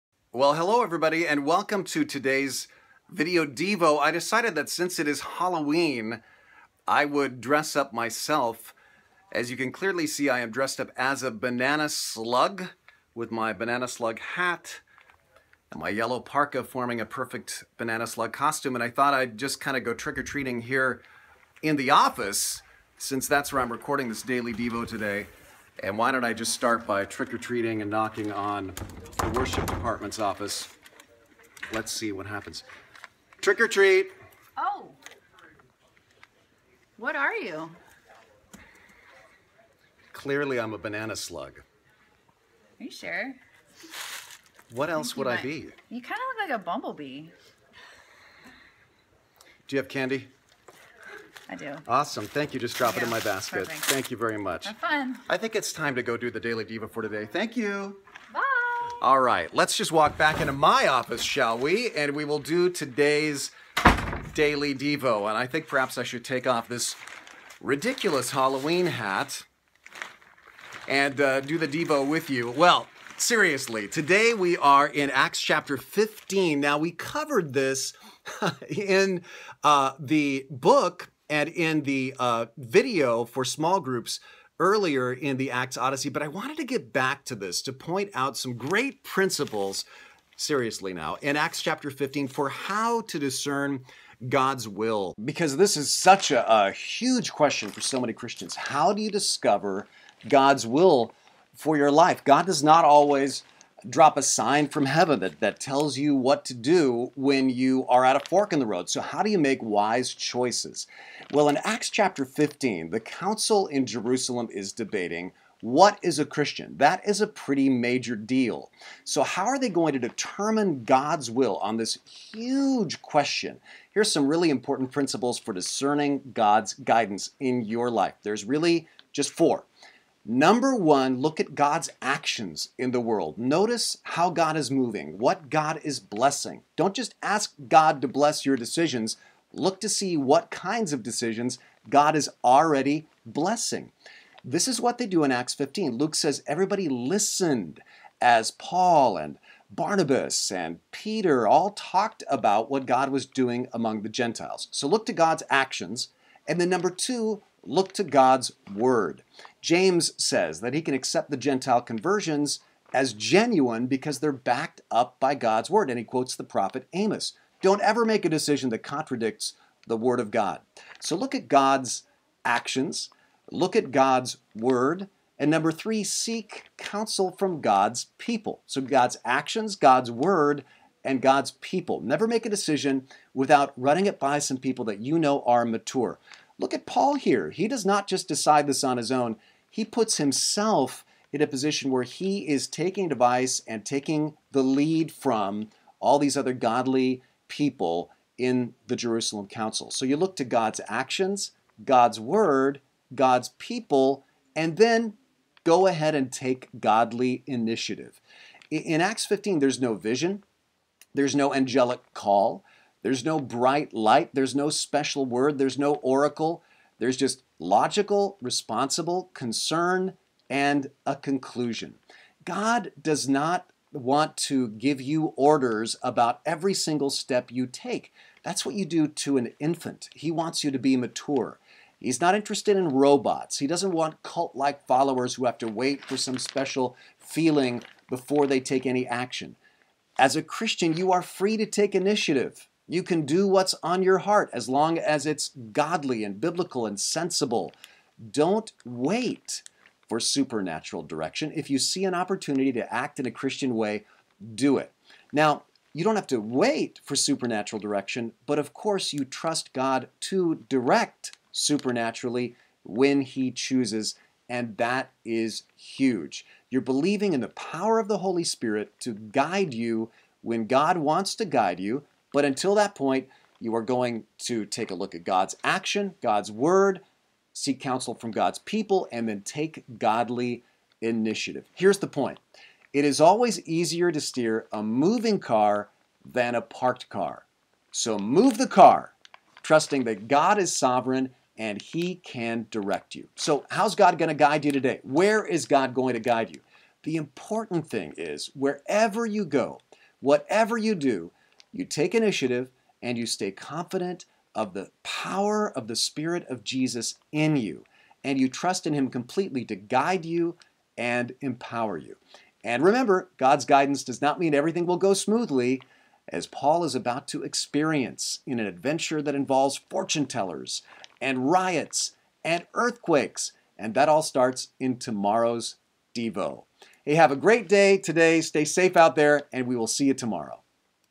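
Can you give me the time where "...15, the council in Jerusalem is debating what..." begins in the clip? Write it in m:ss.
1:52.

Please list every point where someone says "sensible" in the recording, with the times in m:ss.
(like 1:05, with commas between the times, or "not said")
4:06.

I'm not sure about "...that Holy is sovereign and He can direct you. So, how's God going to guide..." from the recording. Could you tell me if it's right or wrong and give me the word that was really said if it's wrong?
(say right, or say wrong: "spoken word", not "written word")
wrong: "God", not "Holy".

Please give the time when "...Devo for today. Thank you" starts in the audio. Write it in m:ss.
0:56.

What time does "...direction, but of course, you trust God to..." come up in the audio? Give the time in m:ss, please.
4:17.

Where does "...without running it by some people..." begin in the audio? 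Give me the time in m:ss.
3:03.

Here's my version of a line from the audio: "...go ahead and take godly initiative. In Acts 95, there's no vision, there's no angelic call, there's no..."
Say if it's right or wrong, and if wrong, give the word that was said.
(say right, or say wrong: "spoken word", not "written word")
wrong: "15", not "95".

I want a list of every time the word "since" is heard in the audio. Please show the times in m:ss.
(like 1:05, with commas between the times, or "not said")
0:04, 0:22.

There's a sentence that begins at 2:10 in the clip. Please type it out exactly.
Number one, look at God's actions in the world.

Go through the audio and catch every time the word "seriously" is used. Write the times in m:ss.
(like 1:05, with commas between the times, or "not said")
1:13, 1:30.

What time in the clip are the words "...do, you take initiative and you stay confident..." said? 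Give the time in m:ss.
5:00.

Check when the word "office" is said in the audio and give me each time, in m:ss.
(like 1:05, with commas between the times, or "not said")
0:21, 0:30, 1:00.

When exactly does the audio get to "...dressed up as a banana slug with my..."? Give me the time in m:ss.
0:10.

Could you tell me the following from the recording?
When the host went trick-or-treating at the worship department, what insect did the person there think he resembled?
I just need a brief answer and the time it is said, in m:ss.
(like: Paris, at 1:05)
Bumblebee, at 0:46.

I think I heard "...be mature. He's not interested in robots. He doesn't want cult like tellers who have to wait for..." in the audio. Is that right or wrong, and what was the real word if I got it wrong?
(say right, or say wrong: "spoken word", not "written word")
wrong: "followers", not "tellers".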